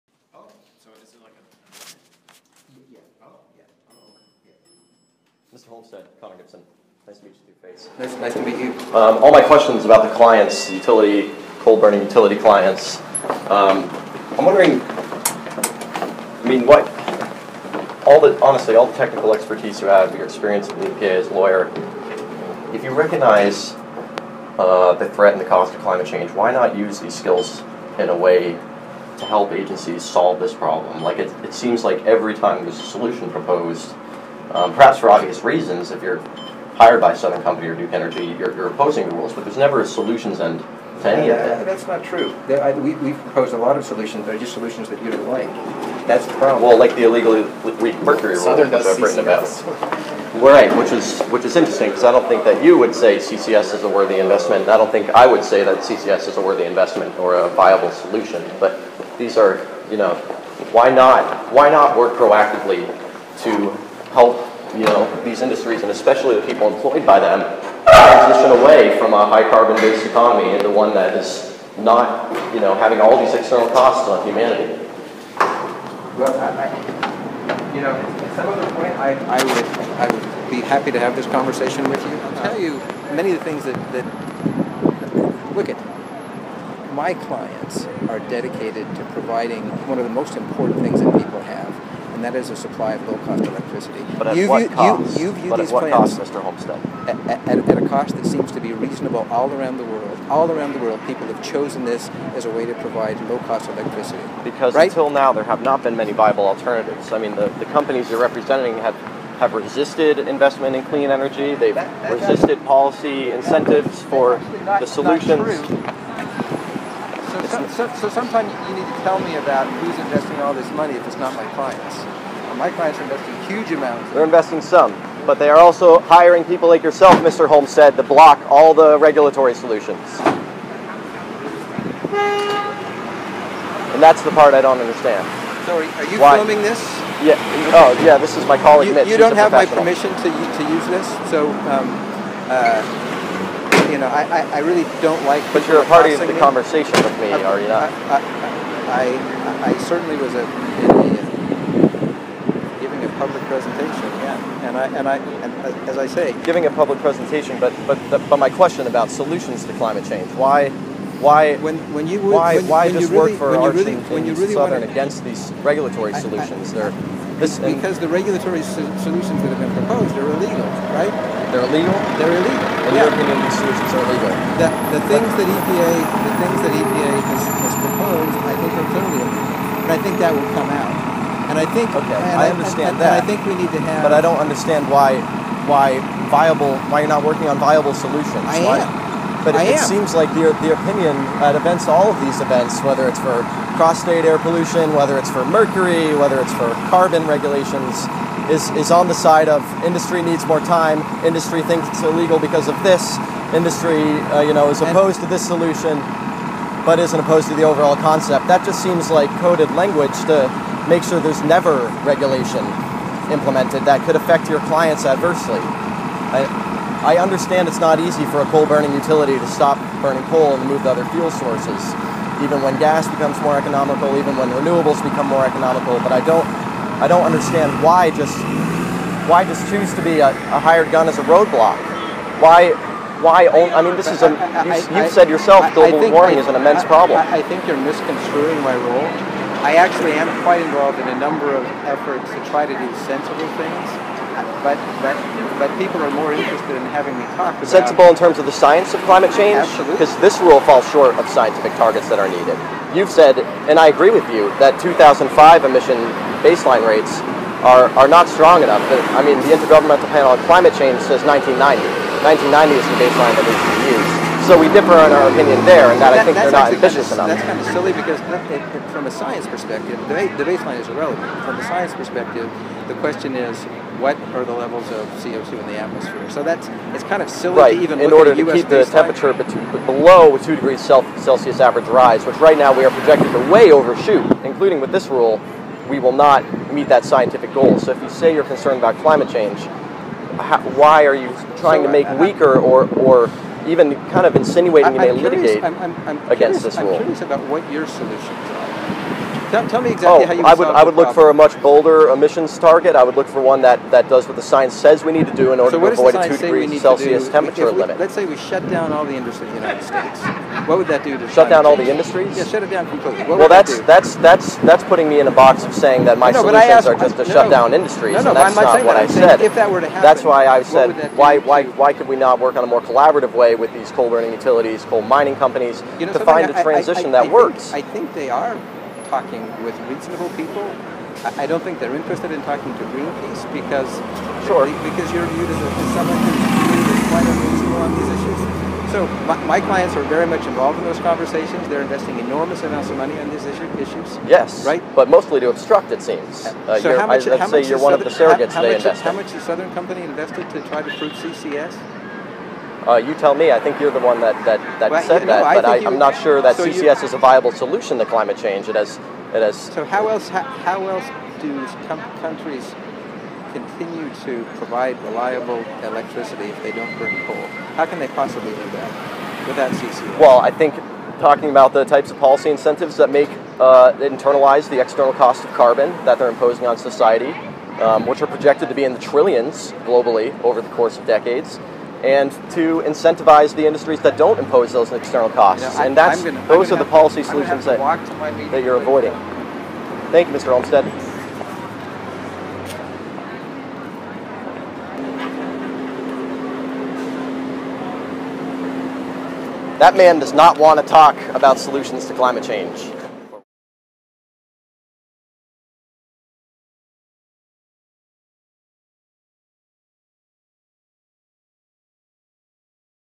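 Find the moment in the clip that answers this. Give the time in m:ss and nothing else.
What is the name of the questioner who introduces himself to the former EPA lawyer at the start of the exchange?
0:06.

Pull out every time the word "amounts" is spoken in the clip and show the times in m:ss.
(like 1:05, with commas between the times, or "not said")
2:03, 5:42.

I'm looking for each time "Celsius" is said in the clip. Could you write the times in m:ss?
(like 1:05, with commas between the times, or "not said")
4:40, 5:06.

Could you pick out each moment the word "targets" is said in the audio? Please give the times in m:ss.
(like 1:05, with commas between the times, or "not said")
4:11, 5:02.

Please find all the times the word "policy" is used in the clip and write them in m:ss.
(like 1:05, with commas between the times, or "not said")
1:52, 6:12, 6:26.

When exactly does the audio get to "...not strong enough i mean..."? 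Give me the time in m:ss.
4:18.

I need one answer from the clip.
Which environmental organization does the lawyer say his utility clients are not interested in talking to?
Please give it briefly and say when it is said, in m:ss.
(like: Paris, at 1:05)
Greenpeace, at 5:32.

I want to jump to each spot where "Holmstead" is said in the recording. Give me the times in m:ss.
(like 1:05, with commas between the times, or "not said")
0:05, 1:36, 2:07, 6:30.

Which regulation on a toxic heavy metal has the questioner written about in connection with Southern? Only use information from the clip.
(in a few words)
mercury rule.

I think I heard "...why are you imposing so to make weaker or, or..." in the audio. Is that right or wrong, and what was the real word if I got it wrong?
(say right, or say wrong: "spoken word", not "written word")
wrong: "trying", not "imposing".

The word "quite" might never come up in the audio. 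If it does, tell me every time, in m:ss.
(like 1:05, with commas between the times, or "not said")
4:00, 5:37.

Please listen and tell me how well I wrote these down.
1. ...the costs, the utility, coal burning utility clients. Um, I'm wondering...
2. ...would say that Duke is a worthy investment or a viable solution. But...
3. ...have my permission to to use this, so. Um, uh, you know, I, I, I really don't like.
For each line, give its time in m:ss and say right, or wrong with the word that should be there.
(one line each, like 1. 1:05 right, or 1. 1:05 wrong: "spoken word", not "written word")
1. 0:10 wrong: "clients", not "costs"
2. 0:55 wrong: "CCS", not "Duke"
3. 2:19 right.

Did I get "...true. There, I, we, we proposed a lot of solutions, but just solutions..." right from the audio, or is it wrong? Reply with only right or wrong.
right.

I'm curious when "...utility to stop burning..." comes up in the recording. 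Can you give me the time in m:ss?
3:38.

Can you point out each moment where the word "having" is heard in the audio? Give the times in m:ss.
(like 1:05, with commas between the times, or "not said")
1:12, 4:06.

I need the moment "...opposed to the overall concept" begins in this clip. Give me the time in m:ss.
3:27.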